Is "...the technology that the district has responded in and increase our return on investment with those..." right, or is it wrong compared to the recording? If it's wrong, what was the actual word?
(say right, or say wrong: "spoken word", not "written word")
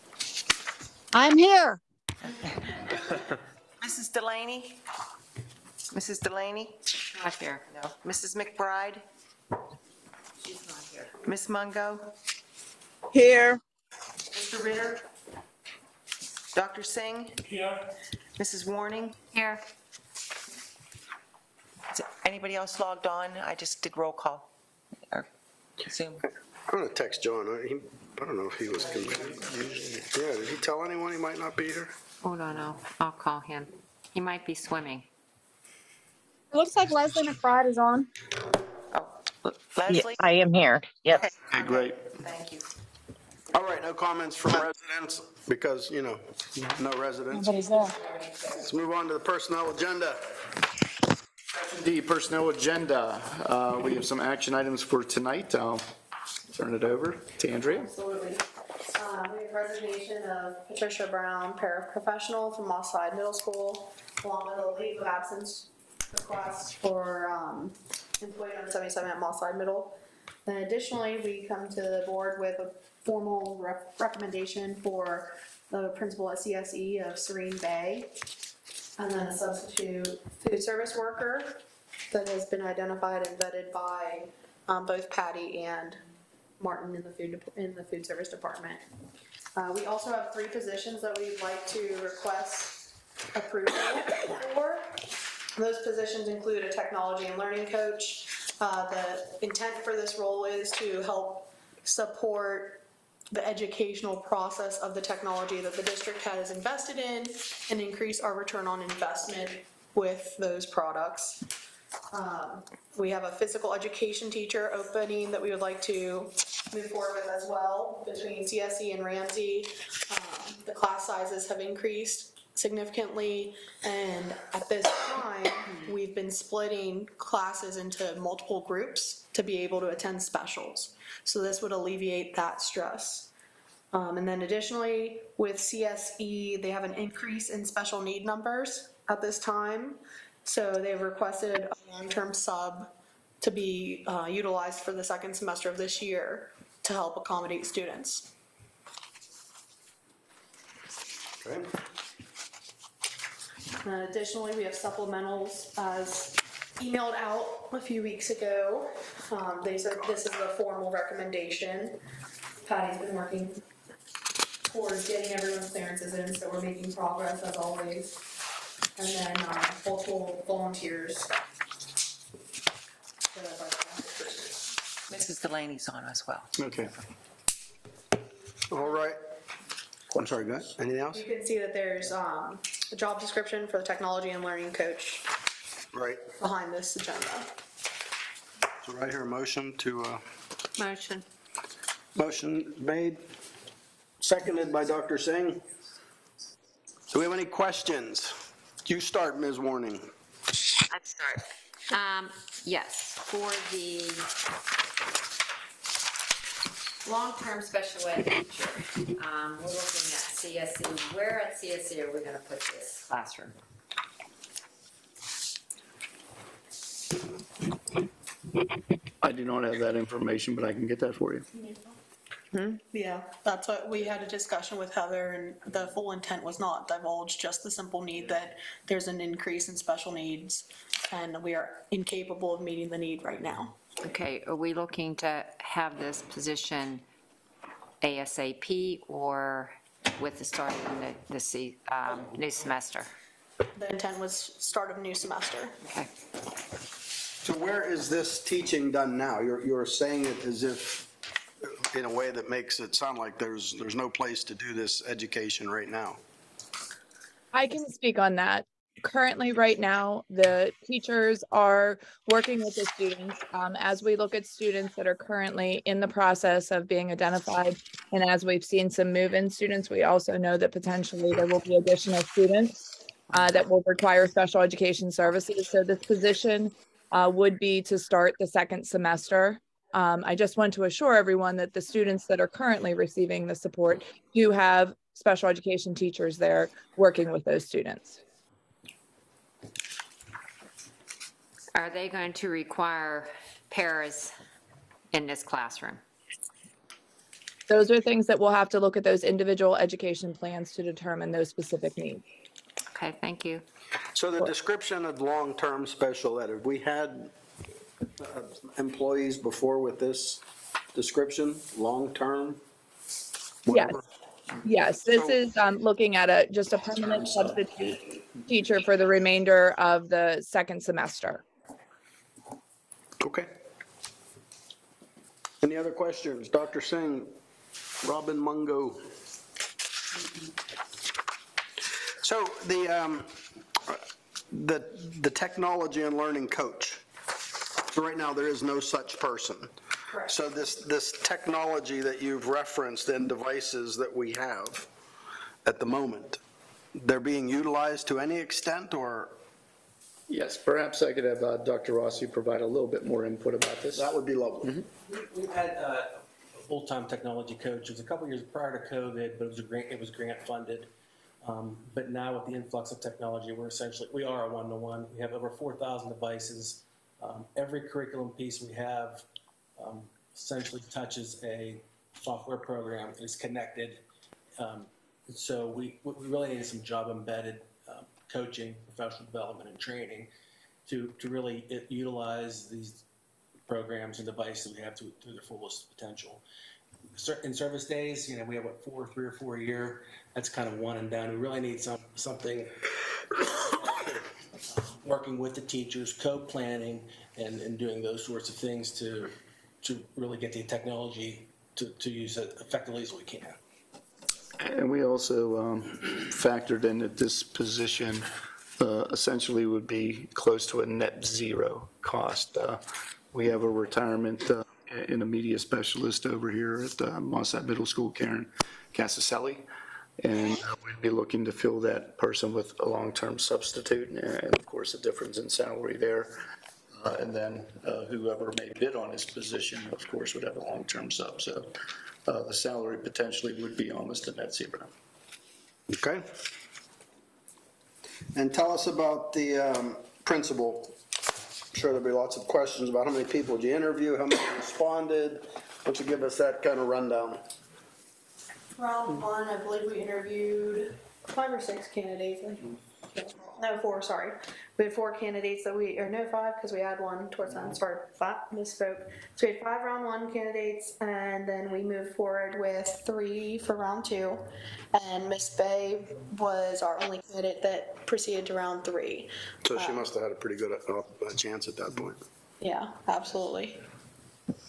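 wrong: "invested", not "responded".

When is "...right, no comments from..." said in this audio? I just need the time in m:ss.
0:43.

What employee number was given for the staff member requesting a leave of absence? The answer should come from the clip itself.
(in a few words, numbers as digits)
77.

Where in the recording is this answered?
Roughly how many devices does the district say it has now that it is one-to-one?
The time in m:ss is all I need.
6:05.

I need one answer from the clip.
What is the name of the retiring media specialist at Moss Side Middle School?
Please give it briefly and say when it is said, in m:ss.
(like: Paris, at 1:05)
Karen Casaselli, at 6:58.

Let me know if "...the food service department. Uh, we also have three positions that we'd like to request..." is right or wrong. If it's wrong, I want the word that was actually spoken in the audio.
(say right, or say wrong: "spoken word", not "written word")
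right.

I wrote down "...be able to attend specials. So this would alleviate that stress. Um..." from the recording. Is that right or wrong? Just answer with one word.
right.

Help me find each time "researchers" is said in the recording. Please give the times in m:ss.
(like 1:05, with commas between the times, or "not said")
not said.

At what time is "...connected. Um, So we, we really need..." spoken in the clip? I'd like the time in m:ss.
6:13.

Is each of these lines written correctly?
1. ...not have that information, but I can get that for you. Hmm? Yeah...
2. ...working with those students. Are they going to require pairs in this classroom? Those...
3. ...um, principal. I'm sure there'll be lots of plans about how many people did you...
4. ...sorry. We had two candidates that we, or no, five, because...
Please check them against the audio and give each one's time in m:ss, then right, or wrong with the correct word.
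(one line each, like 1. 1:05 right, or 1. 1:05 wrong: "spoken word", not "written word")
1. 3:39 right
2. 4:46 right
3. 7:19 wrong: "questions", not "plans"
4. 7:34 wrong: "four", not "two".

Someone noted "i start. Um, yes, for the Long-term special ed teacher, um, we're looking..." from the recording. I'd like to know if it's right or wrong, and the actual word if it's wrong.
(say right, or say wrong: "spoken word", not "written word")
right.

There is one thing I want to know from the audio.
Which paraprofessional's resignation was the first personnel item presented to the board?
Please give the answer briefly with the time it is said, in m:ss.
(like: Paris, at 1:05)
Patricia Brown, at 1:00.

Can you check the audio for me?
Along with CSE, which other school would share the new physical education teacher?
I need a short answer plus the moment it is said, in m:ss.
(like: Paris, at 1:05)
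Ramsey, at 1:59.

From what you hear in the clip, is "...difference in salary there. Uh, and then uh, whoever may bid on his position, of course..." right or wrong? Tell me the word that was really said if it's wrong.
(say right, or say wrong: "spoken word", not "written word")
right.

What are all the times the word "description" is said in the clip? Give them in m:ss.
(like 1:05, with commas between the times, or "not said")
3:03, 5:04, 5:10.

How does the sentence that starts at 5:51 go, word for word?
Rossi provide a little bit more input about this.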